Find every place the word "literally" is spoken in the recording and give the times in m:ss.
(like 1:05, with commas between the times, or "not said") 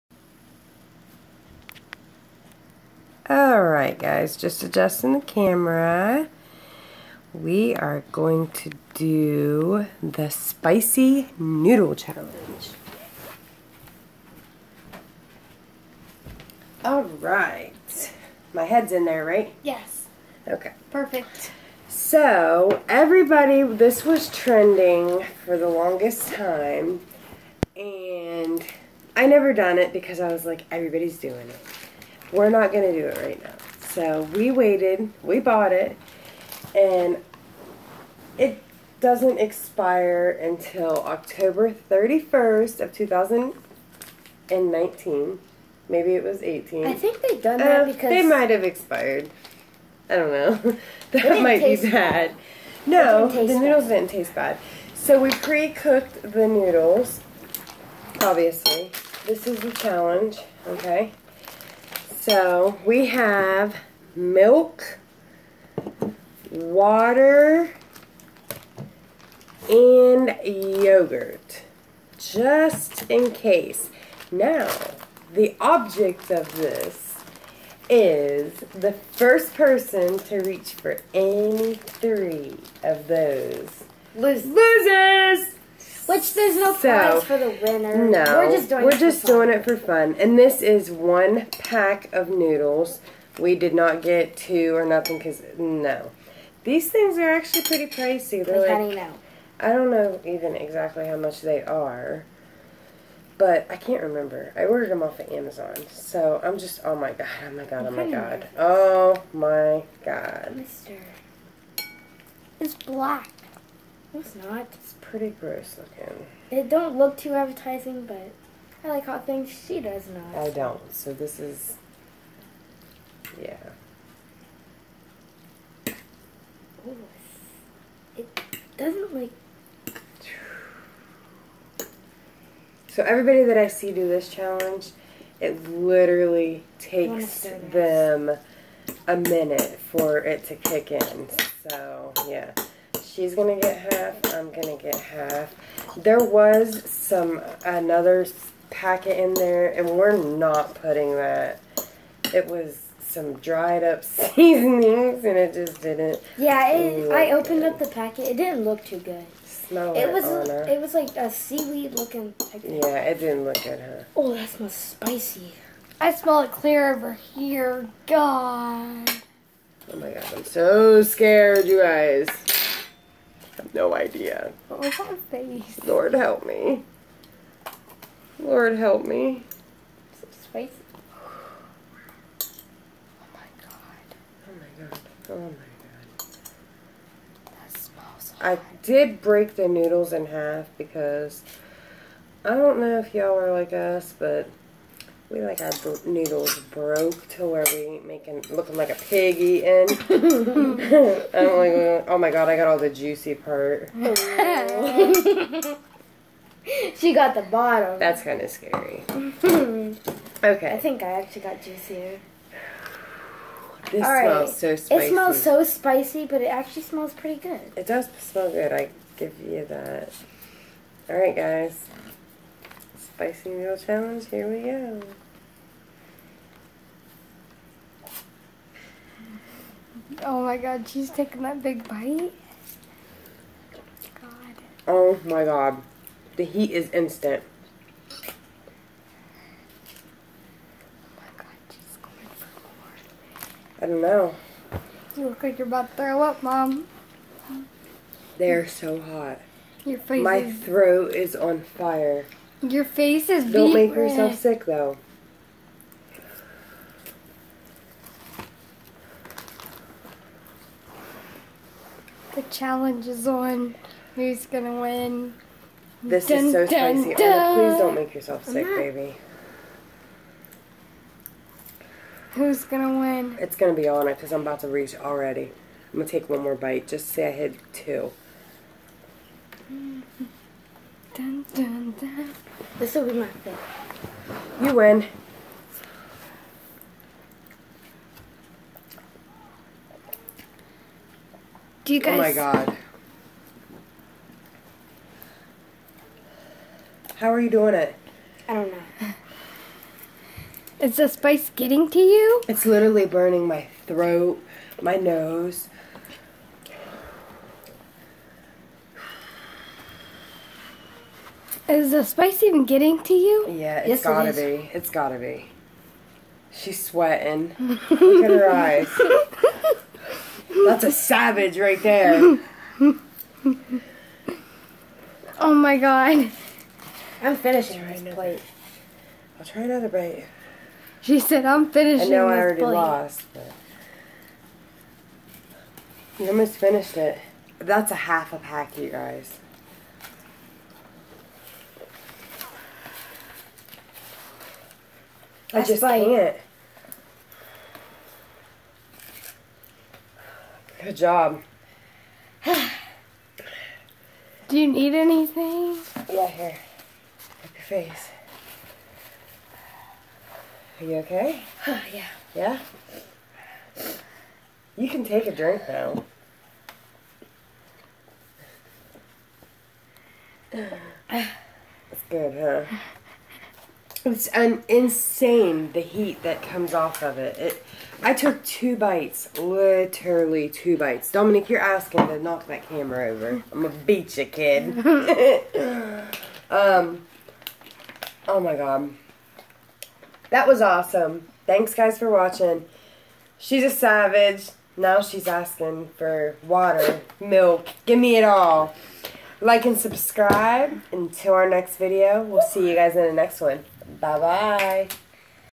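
2:15, 5:02, 6:19.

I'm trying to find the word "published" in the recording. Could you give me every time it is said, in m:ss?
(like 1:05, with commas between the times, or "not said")
not said.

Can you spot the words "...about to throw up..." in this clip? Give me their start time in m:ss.
4:05.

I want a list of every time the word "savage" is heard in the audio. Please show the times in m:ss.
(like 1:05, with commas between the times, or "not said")
5:20, 6:33.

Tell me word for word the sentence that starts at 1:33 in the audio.
We did not get two or nothing because no, these things are actually pretty pricey.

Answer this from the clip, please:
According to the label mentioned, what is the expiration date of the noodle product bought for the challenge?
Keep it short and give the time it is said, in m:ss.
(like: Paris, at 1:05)
October 31st, at 0:41.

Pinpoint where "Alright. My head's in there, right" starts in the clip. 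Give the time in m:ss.
0:16.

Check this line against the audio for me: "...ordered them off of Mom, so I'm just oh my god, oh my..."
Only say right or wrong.
wrong.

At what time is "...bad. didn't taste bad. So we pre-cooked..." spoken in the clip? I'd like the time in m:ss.
0:53.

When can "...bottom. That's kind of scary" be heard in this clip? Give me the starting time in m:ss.
3:27.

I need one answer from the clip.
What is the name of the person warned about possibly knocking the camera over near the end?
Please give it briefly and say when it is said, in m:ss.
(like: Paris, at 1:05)
Dominic, at 6:21.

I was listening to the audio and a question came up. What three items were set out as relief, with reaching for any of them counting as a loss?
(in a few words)
milk, water, and yogurt.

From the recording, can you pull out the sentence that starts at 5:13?
Yeah, it's yes, gotta it be.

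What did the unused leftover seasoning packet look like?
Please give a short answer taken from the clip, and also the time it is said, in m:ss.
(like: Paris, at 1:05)
seaweed, at 2:41.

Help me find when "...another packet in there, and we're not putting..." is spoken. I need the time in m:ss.
2:27.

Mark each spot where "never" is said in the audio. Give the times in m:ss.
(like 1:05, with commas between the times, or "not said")
0:29.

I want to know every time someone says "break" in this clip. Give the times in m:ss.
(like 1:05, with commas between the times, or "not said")
3:09.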